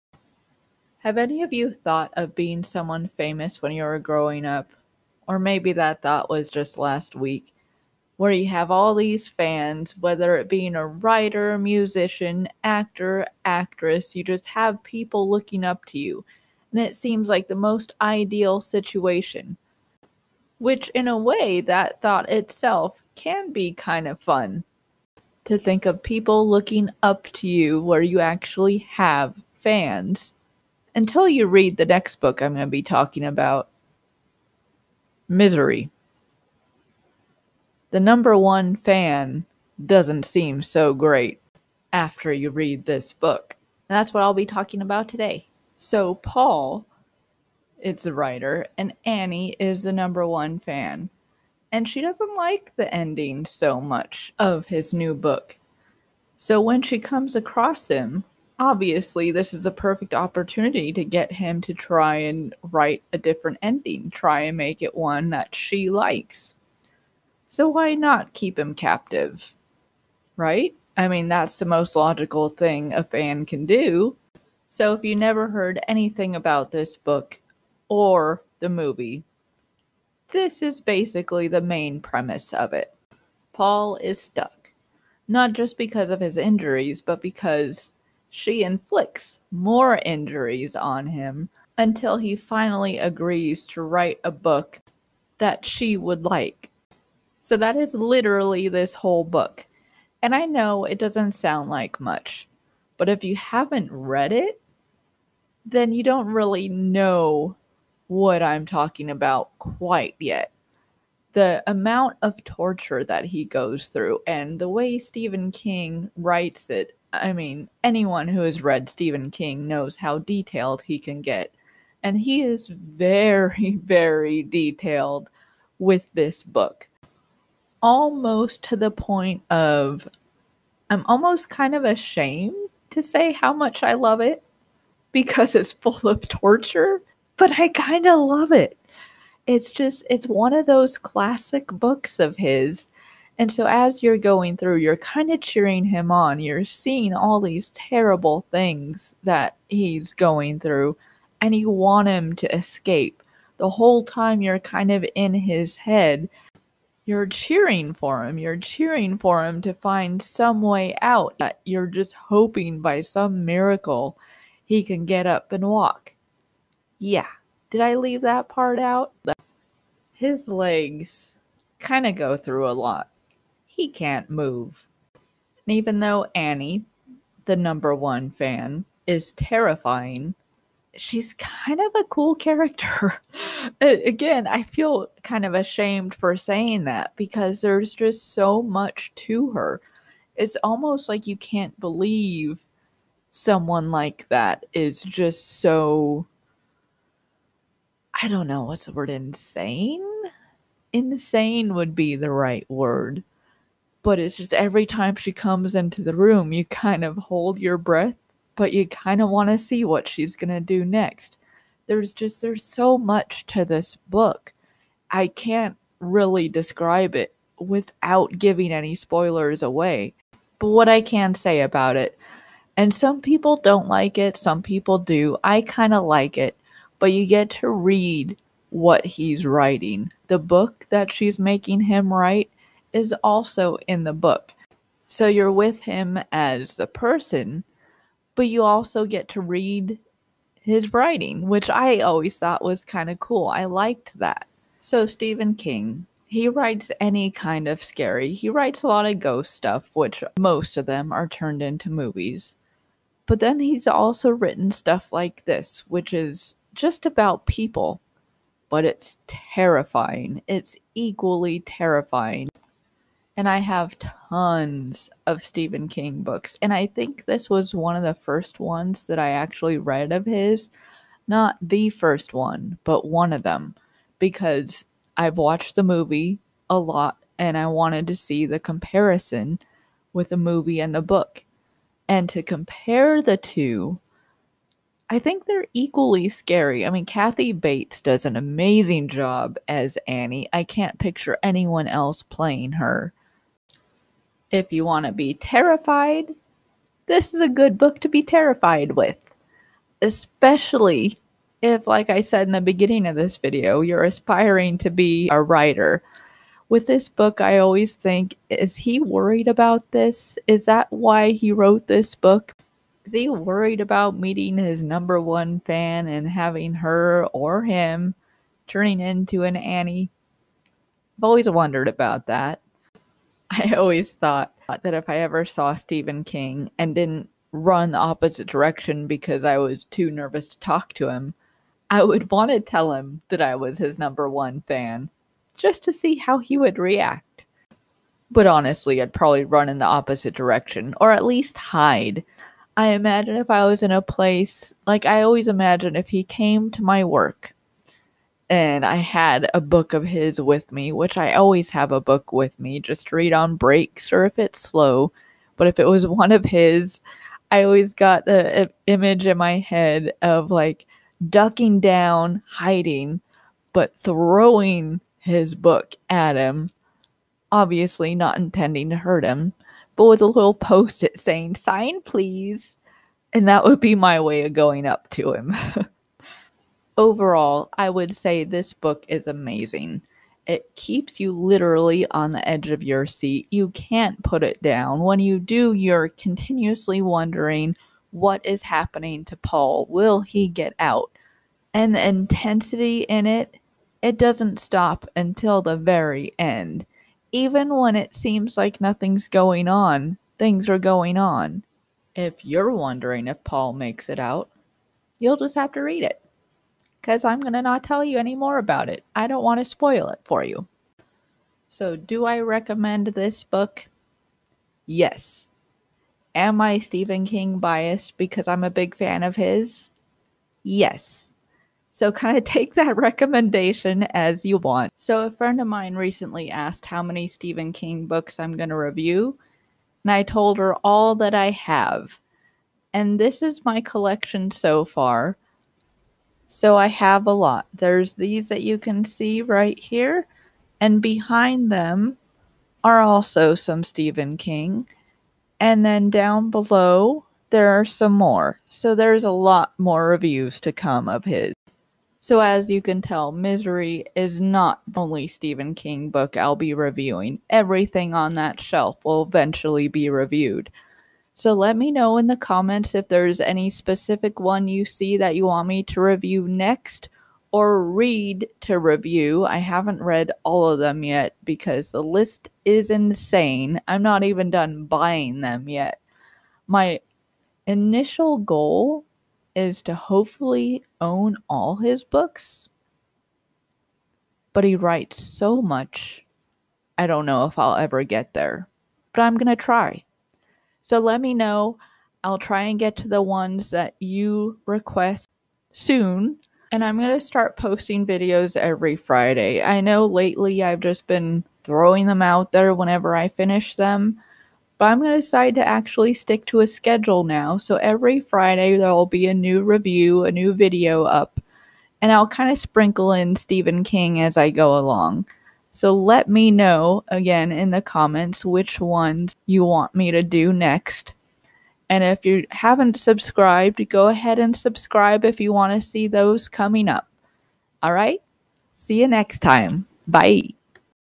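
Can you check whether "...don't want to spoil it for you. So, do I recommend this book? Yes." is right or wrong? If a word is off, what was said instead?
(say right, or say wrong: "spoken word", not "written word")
right.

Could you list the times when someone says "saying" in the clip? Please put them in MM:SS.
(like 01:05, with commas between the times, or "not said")
03:06, 06:11.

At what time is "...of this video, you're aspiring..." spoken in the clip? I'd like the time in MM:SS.
05:03.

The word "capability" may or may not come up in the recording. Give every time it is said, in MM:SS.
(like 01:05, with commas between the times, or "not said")
not said.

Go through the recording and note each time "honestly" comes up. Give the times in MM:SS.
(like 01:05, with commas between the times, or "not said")
05:38.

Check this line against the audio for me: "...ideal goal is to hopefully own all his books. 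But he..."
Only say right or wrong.
wrong.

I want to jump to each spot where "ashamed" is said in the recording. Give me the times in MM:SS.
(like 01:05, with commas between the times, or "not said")
02:11, 03:05.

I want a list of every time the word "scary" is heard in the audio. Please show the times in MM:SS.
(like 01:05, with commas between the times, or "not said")
04:07, 04:46.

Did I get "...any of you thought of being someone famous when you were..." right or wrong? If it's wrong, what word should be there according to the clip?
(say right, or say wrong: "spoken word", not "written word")
right.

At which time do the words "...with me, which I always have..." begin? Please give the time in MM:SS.
05:50.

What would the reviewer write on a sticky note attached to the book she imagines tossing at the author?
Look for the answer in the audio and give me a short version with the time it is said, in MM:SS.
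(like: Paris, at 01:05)
sign please, at 06:11.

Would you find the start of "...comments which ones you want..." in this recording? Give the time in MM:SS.
08:37.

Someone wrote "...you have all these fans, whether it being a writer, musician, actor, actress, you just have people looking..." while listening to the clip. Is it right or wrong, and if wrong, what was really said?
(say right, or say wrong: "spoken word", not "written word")
right.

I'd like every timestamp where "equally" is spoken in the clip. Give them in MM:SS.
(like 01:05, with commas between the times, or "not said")
04:20, 04:45.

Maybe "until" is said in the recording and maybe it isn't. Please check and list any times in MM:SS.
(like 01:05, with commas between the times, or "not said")
00:30, 01:31, 06:35.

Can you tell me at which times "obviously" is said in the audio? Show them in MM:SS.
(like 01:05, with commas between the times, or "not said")
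00:58, 06:07.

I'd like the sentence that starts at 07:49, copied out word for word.
I haven't read all of them yet because the list is insane.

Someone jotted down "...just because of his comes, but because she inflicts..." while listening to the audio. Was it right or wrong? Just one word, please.
wrong.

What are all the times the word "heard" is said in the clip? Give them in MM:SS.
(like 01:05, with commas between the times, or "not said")
01:15.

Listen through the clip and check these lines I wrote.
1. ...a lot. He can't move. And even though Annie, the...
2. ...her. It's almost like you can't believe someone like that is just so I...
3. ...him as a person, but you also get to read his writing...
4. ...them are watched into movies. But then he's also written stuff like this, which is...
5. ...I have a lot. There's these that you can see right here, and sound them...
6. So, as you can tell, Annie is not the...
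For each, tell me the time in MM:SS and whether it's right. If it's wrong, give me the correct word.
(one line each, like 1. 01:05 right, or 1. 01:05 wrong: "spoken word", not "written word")
1. 02:52 right
2. 03:09 right
3. 03:55 right
4. 04:10 wrong: "turned", not "watched"
5. 07:16 wrong: "behind", not "sound"
6. 07:32 wrong: "Misery", not "Annie".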